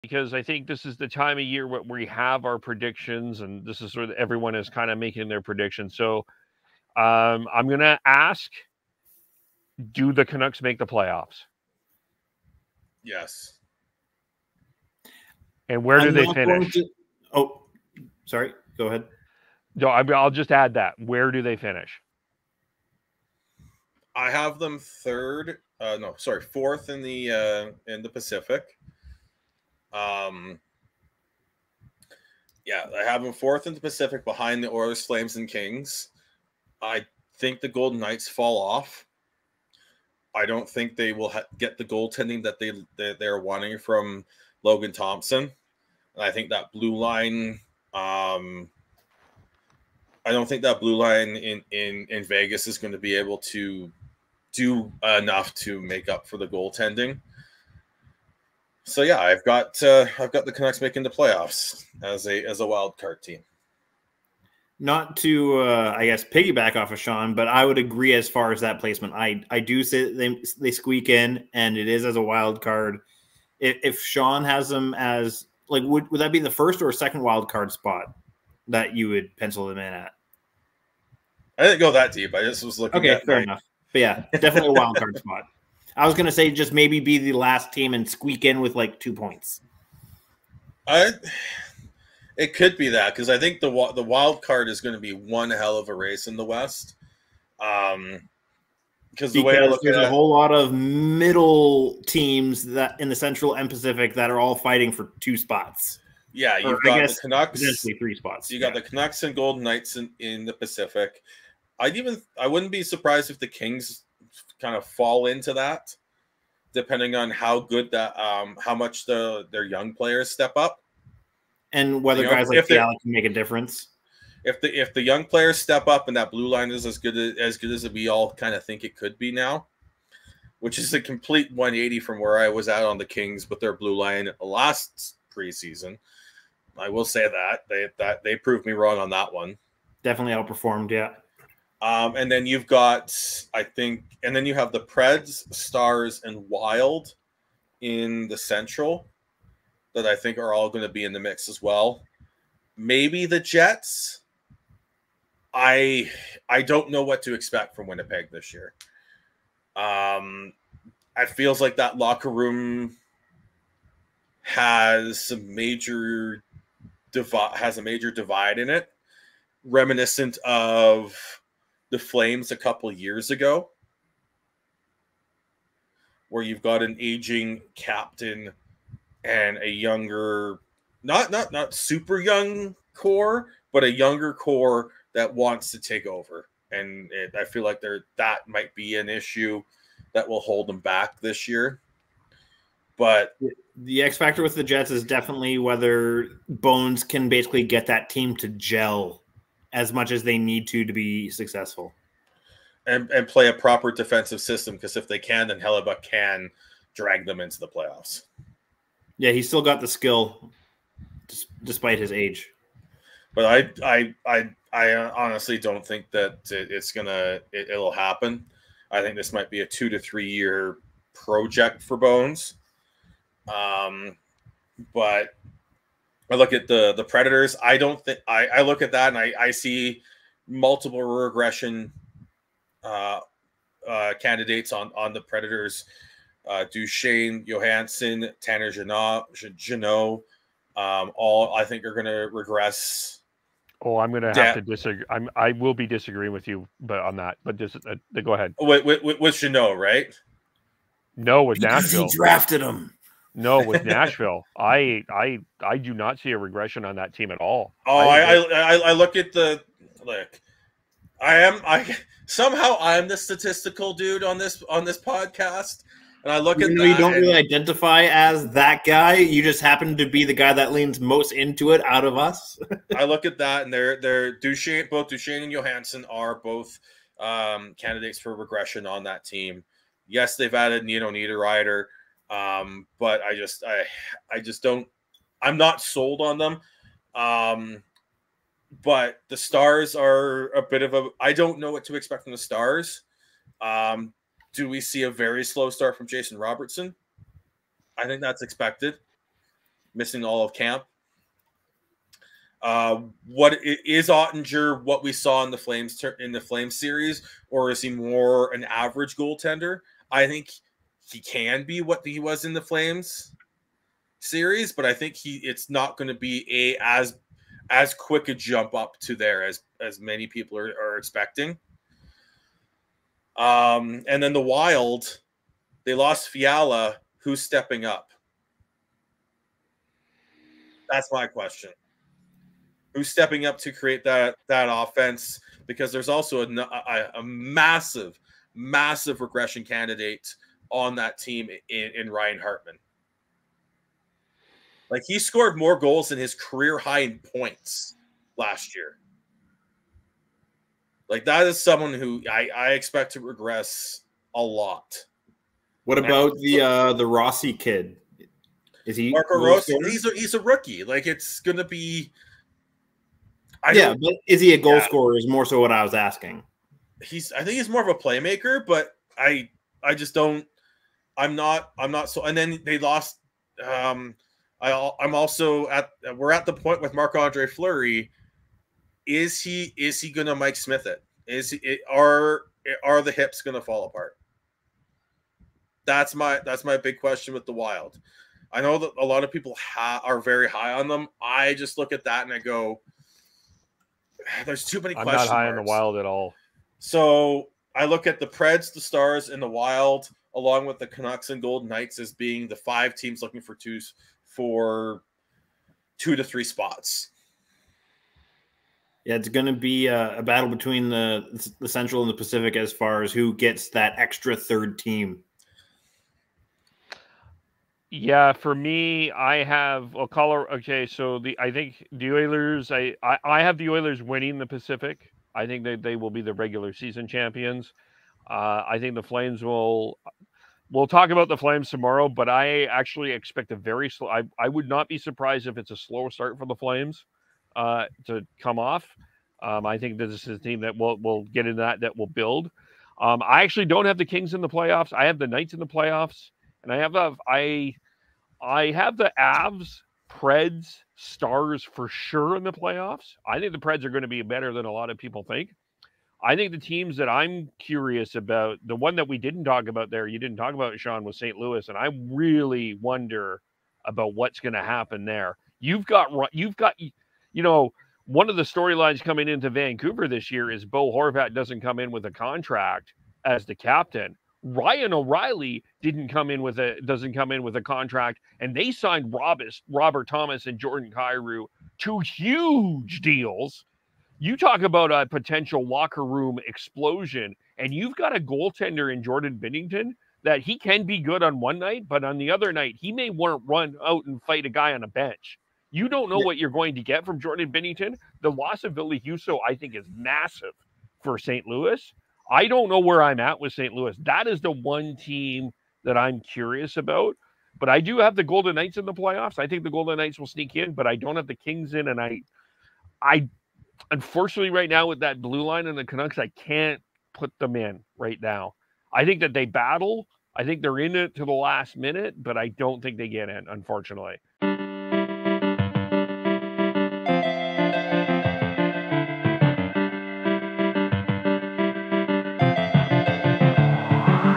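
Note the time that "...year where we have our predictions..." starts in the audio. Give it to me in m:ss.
0:01.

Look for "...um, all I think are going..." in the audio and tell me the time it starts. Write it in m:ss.
4:00.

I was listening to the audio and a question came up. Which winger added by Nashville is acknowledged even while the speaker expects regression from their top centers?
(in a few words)
Nino Niederreiter.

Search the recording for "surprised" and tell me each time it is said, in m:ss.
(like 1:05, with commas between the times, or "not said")
1:52, 7:14.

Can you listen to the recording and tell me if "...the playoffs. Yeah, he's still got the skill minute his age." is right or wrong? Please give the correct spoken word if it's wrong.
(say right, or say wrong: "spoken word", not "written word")
wrong: "despite", not "minute".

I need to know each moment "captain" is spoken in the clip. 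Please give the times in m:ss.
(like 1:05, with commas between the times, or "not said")
2:57, 7:53.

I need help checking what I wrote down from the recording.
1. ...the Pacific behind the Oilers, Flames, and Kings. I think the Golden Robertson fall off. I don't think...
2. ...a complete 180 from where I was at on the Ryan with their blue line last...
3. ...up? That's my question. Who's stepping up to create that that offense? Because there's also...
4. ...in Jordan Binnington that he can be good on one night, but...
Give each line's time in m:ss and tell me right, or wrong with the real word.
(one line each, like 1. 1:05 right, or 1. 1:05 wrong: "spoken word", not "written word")
1. 0:33 wrong: "Knights", not "Robertson"
2. 2:10 wrong: "Kings", not "Ryan"
3. 5:27 right
4. 8:08 right.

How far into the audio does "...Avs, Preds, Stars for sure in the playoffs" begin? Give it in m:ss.
7:29.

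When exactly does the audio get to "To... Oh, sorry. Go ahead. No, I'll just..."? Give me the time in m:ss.
0:16.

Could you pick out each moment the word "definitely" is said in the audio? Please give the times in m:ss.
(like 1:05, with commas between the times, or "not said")
1:24, 2:20, 3:15.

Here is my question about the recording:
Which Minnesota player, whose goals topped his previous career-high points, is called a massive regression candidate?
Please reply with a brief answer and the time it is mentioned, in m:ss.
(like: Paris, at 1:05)
Ryan Hartman, at 5:42.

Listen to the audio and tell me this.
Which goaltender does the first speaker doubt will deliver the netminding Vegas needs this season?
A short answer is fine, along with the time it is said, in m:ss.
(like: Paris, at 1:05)
Logan Thompson, at 0:44.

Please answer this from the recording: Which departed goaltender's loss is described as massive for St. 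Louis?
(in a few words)
Ville Husso.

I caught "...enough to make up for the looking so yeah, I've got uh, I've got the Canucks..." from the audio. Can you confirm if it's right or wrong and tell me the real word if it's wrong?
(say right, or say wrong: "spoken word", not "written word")
wrong: "goaltending", not "looking".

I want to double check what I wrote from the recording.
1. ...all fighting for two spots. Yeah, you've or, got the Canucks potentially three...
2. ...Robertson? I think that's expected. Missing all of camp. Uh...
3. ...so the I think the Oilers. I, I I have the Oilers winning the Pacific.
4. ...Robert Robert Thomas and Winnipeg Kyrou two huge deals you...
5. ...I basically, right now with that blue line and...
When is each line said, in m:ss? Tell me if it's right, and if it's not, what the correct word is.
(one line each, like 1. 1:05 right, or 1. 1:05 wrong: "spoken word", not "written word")
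1. 1:44 right
2. 4:56 right
3. 7:00 right
4. 7:59 wrong: "Jordan", not "Winnipeg"
5. 8:33 wrong: "unfortunately", not "basically".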